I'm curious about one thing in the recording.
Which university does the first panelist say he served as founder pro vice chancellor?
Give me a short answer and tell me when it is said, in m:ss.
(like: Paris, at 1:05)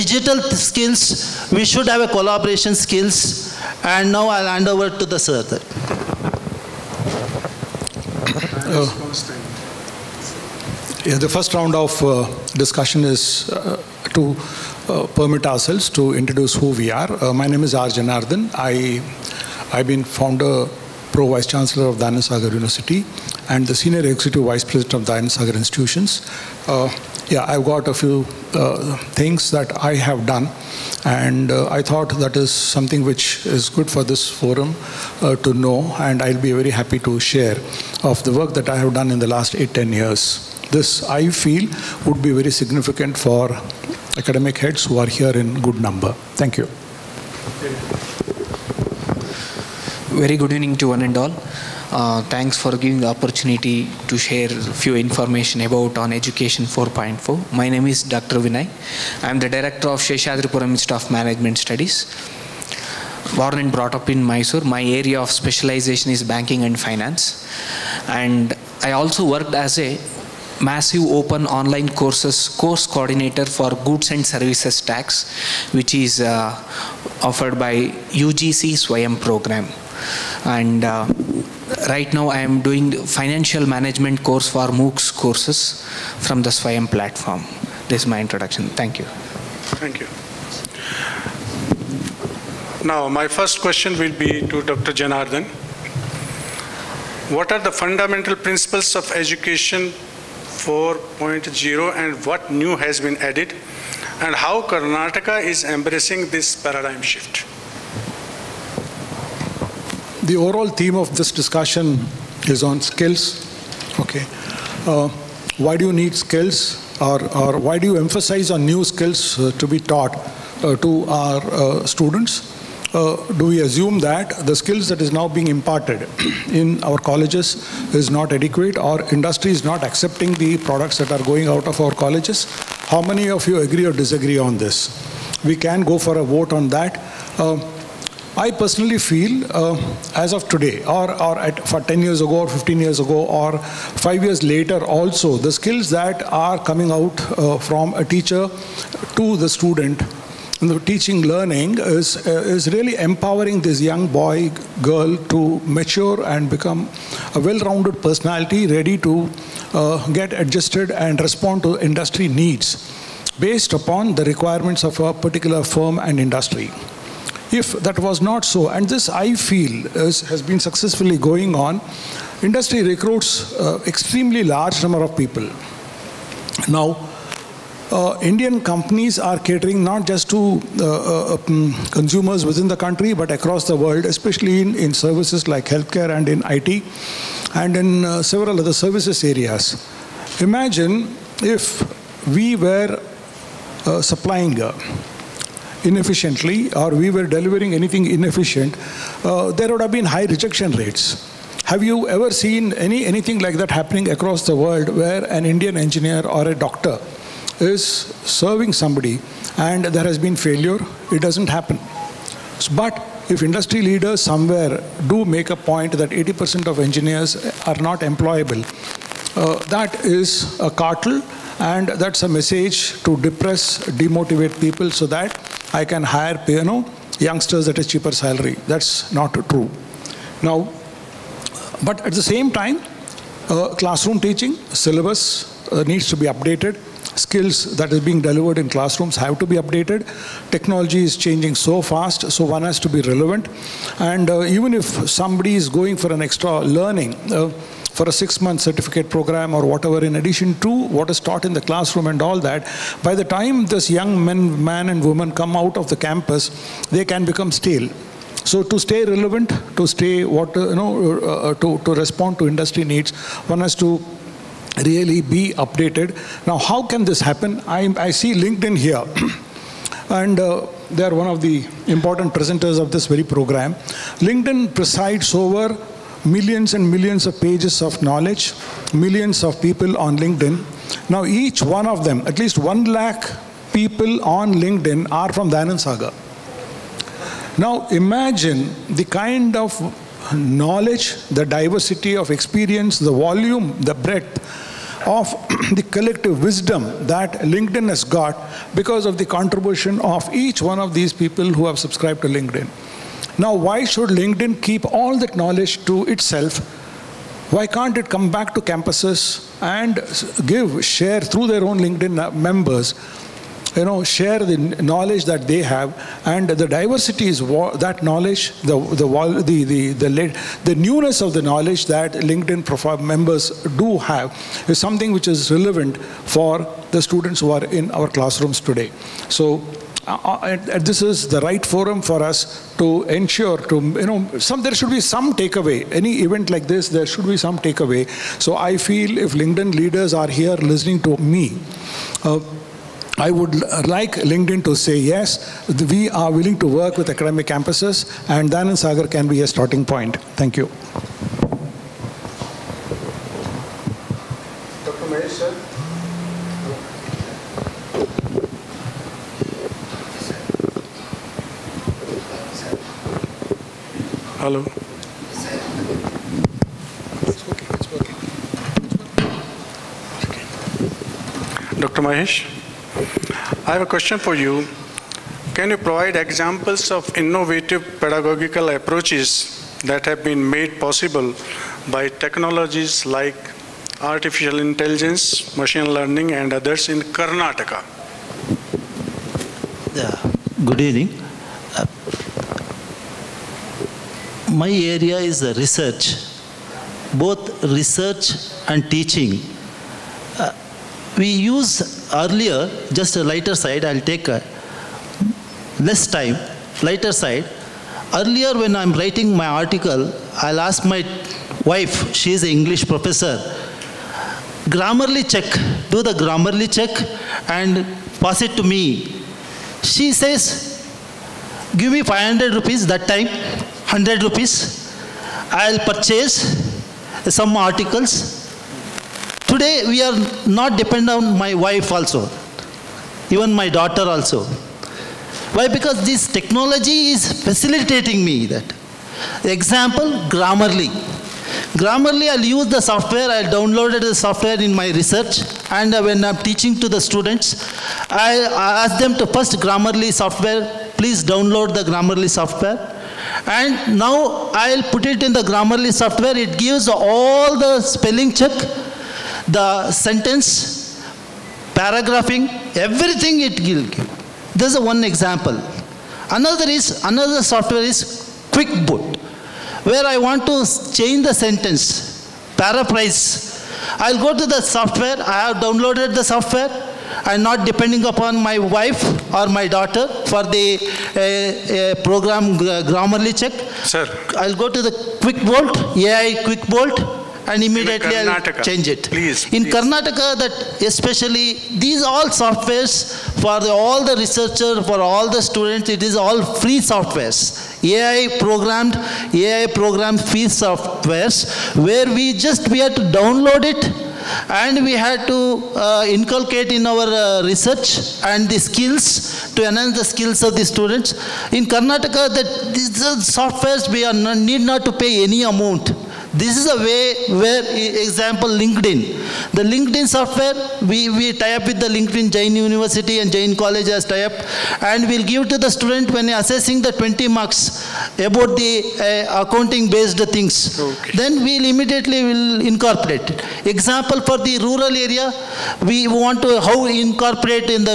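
Dayananda Sagar University, at 0:21.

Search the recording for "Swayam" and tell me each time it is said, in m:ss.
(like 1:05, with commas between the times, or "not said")
1:18, 1:26.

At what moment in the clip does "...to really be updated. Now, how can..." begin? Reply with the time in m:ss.
4:23.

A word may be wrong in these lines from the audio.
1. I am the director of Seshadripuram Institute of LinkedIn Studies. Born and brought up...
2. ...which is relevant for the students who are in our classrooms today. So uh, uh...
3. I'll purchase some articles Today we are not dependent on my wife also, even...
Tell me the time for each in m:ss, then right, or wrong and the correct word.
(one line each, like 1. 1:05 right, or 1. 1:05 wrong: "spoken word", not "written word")
1. 0:59 wrong: "Management", not "LinkedIn"
2. 5:25 right
3. 7:05 right.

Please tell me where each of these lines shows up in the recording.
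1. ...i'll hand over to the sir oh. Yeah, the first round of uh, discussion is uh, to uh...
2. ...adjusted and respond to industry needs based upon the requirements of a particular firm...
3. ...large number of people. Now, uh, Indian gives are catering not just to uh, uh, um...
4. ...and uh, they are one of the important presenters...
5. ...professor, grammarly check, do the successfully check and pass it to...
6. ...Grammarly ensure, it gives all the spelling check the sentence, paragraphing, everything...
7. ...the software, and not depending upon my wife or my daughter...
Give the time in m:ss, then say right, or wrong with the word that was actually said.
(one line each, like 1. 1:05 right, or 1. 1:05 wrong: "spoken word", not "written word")
1. 0:04 right
2. 2:40 right
3. 2:54 wrong: "companies", not "gives"
4. 4:30 right
5. 6:52 wrong: "grammarly", not "successfully"
6. 7:35 wrong: "software", not "ensure"
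7. 7:56 right.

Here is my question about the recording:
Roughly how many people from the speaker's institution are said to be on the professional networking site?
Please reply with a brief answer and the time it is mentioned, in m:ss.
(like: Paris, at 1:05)
one lakh, at 4:42.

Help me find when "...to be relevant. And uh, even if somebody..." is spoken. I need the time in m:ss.
4:02.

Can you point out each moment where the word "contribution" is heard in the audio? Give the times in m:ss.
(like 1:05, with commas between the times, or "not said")
4:59.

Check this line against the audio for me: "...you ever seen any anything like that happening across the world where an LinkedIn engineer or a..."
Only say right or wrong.
wrong.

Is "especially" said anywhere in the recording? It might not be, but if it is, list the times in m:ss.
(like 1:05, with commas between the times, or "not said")
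3:04, 8:10.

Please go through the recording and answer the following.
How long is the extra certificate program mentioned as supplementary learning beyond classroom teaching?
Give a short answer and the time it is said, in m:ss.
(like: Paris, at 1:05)
six-month, at 4:08.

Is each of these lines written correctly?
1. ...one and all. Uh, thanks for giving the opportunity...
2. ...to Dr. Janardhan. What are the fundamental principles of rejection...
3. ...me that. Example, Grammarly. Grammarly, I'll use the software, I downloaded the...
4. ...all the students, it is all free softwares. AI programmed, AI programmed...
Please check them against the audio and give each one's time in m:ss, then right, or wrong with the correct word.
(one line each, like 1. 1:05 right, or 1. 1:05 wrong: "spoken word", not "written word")
1. 0:50 right
2. 1:34 wrong: "education", not "rejection"
3. 7:18 right
4. 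8:15 right.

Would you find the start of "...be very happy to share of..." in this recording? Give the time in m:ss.
0:36.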